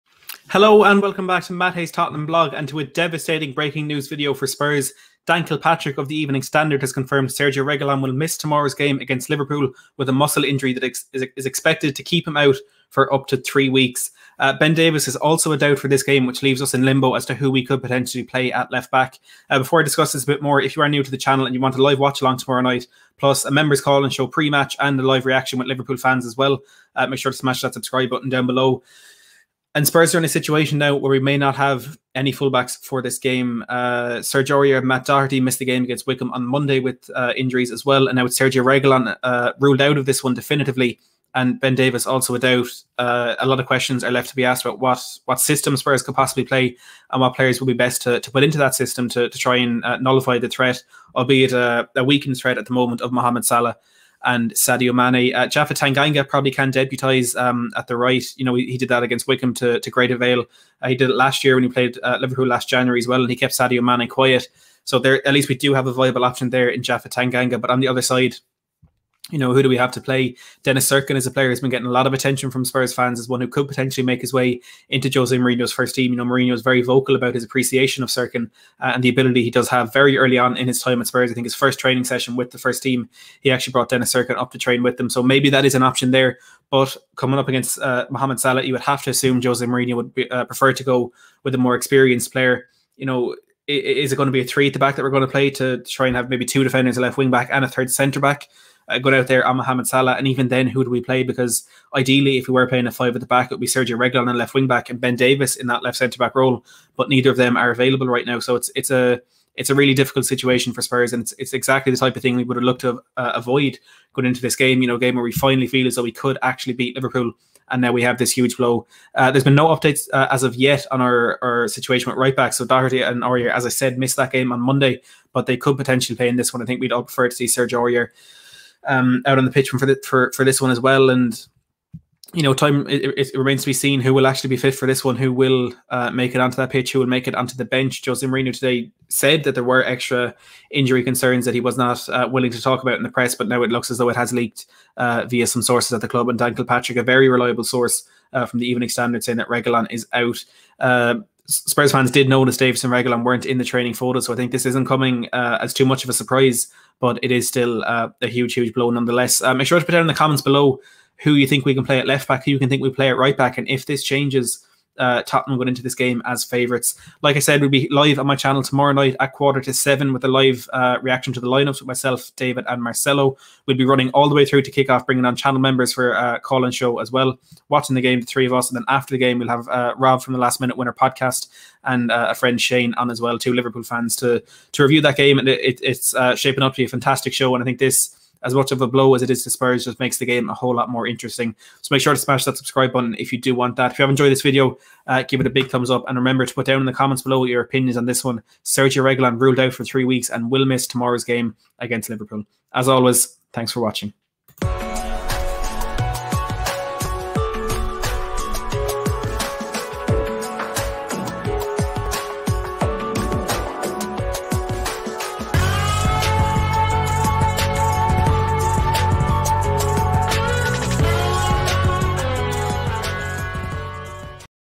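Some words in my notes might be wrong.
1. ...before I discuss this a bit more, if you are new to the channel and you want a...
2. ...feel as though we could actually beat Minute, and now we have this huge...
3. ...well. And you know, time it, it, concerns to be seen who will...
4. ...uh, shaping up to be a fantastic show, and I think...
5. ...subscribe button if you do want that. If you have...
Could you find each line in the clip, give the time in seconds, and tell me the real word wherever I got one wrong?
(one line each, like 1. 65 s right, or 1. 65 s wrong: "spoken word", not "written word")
1. 19 s right
2. 115 s wrong: "Liverpool", not "Minute"
3. 130 s wrong: "remains", not "concerns"
4. 186 s right
5. 192 s right.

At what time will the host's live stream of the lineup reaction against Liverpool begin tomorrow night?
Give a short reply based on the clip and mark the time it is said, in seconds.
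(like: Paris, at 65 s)
Quarter to seven, at 169 s.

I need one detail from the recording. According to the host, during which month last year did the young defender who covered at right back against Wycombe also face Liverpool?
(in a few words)
January.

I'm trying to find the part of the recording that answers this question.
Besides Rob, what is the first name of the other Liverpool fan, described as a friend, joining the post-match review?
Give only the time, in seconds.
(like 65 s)
182 s.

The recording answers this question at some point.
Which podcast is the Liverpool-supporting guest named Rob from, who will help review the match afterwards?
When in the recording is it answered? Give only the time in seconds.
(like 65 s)
180 s.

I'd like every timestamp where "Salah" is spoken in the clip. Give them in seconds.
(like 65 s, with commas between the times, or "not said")
53 s, 88 s, 99 s.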